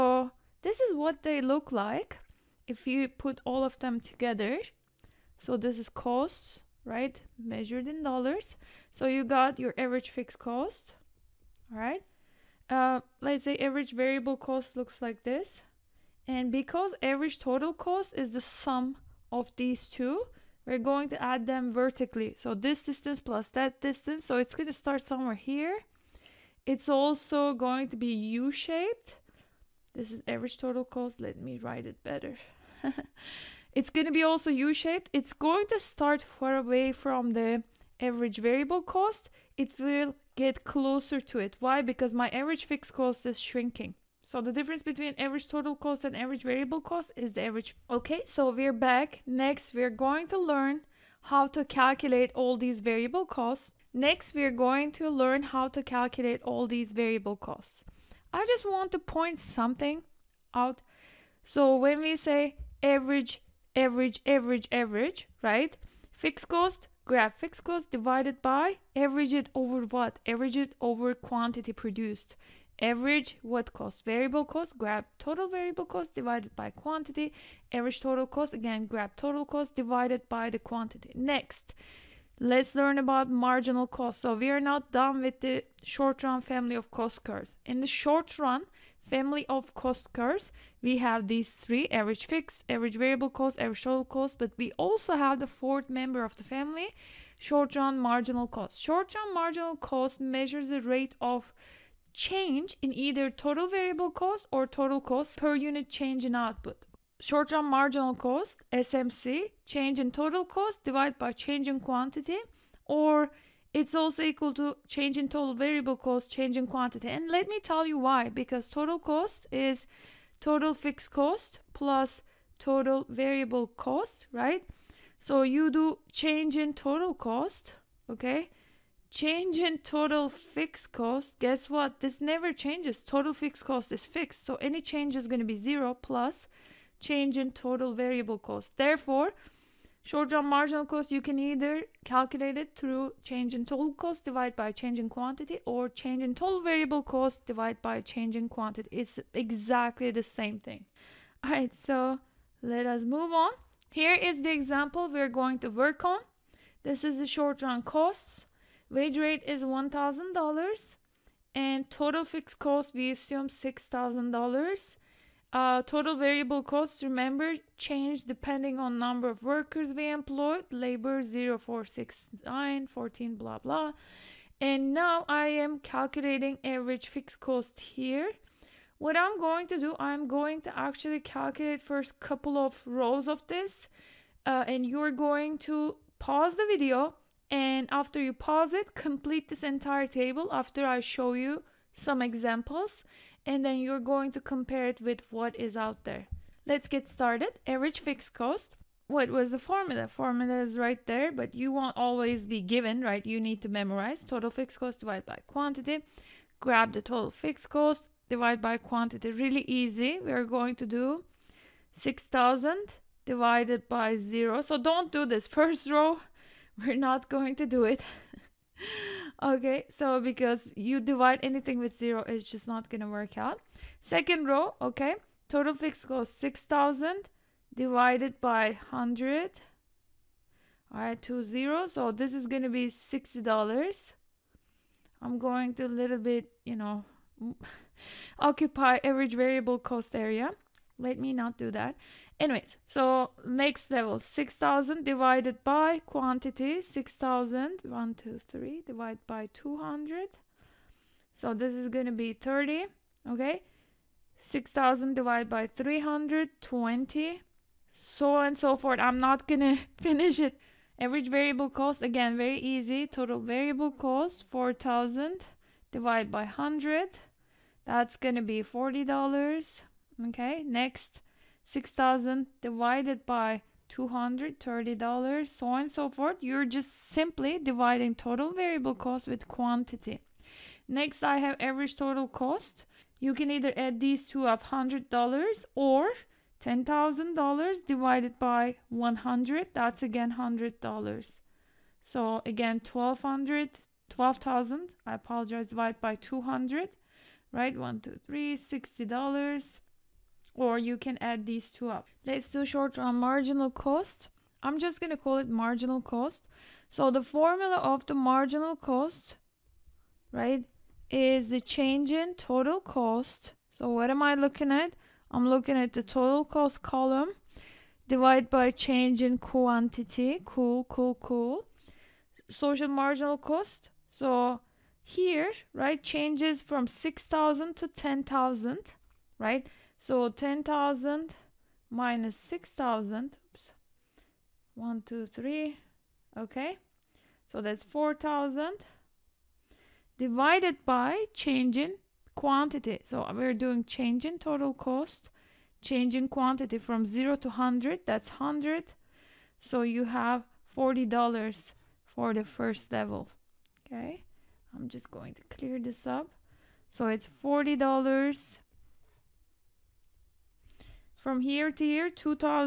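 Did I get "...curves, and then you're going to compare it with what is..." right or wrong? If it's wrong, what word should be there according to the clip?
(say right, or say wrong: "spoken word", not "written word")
wrong: "examples", not "curves".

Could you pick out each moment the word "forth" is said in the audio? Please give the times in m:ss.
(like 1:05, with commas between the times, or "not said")
4:18, 4:36.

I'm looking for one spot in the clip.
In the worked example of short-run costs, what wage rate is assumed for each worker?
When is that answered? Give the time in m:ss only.
2:38.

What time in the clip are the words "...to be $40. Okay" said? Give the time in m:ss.
4:28.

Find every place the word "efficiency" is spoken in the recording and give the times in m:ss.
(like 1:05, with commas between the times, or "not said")
not said.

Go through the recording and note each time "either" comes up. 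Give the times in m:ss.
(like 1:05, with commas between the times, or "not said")
1:42, 2:21, 4:43.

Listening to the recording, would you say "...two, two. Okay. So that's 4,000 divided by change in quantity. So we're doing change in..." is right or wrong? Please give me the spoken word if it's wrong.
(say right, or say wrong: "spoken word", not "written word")
wrong: "three", not "two".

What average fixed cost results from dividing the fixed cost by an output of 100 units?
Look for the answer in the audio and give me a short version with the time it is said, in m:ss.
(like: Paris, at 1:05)
$60, at 3:52.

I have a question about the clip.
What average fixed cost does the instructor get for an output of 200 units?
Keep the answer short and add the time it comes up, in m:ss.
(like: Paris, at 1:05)
30, at 4:11.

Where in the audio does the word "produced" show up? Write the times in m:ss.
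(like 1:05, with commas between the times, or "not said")
1:11.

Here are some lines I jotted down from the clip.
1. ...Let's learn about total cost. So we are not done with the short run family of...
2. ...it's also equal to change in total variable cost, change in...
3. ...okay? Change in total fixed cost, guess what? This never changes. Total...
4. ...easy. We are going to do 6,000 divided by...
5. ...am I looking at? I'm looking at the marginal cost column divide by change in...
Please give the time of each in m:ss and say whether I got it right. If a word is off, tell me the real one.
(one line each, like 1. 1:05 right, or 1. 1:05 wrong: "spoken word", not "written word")
1. 1:22 wrong: "marginal", not "total"
2. 1:53 right
3. 2:08 right
4. 3:29 right
5. 5:14 wrong: "total", not "marginal".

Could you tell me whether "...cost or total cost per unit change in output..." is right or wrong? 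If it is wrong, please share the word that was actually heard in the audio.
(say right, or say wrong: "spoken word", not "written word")
right.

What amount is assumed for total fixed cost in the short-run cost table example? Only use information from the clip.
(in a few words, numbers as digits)
$6,000.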